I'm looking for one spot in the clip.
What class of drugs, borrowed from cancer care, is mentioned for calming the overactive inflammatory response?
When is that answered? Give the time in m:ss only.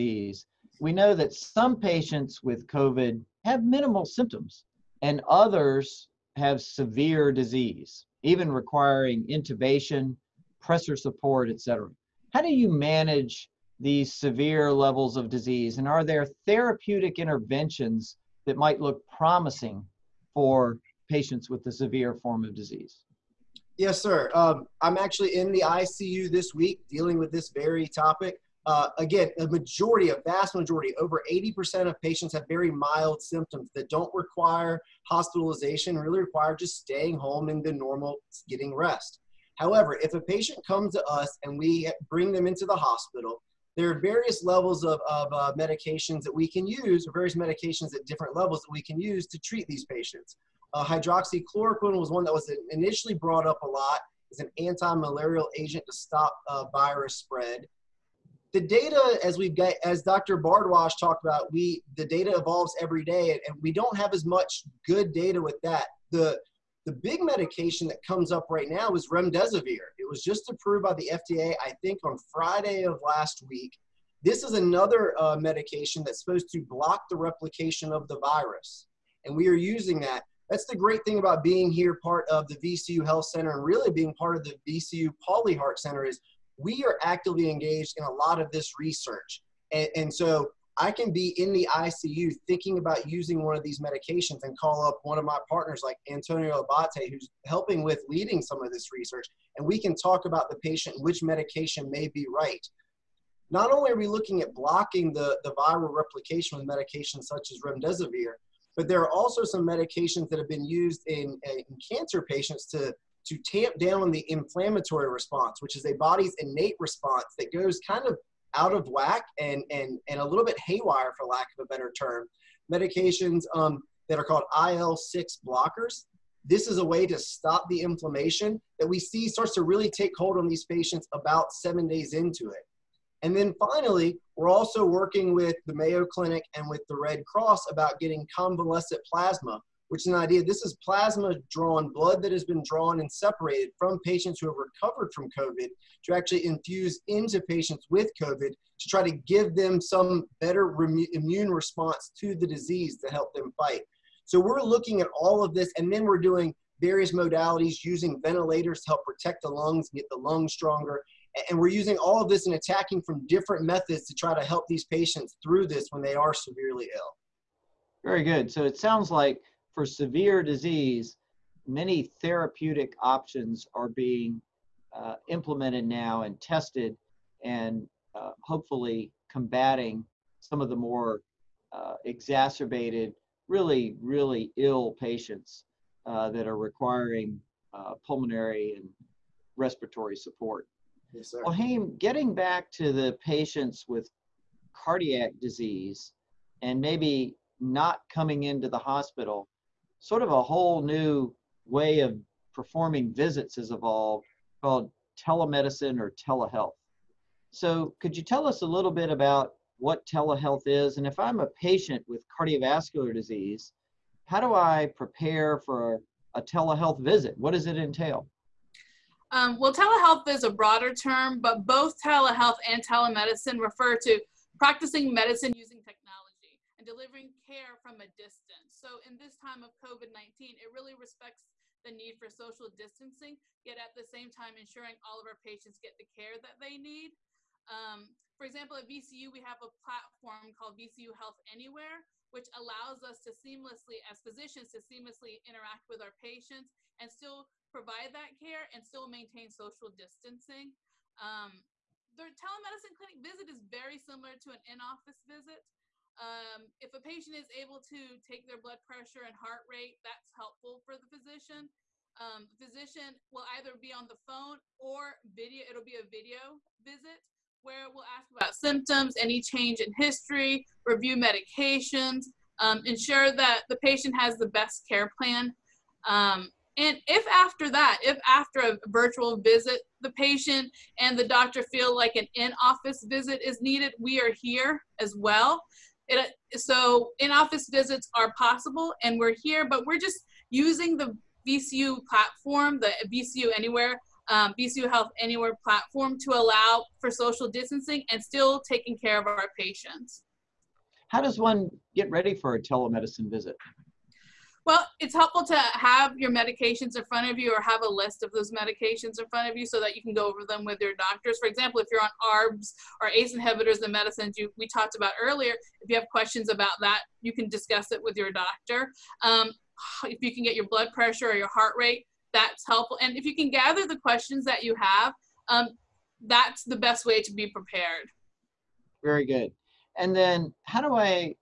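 2:04.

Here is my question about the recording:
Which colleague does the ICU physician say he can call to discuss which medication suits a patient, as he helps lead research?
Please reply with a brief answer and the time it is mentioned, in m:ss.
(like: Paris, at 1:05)
Antonio Abbate, at 1:36.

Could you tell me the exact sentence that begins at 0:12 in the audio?
How do you manage these severe levels of disease?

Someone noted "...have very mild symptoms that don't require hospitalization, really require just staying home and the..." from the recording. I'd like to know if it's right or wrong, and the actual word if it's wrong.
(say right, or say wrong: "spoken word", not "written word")
right.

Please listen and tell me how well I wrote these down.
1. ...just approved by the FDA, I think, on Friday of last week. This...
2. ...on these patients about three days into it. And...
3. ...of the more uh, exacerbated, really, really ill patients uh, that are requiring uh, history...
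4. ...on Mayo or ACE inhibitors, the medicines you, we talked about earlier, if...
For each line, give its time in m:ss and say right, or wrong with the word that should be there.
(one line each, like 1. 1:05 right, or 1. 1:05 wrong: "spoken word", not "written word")
1. 1:10 right
2. 2:10 wrong: "seven", not "three"
3. 3:00 wrong: "pulmonary", not "history"
4. 5:12 wrong: "ARBs", not "Mayo".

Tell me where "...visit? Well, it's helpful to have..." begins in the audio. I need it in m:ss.
5:03.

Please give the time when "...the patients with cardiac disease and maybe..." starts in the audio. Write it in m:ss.
3:12.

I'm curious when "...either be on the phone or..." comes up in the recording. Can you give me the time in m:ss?
4:23.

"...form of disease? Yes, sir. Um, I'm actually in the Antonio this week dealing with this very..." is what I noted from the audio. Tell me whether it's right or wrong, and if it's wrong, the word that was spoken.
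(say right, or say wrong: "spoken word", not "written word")
wrong: "ICU", not "Antonio".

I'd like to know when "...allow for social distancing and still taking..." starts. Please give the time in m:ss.
4:56.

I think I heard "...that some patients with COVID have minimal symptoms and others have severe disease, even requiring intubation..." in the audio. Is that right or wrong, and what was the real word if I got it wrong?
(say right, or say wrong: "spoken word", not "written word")
right.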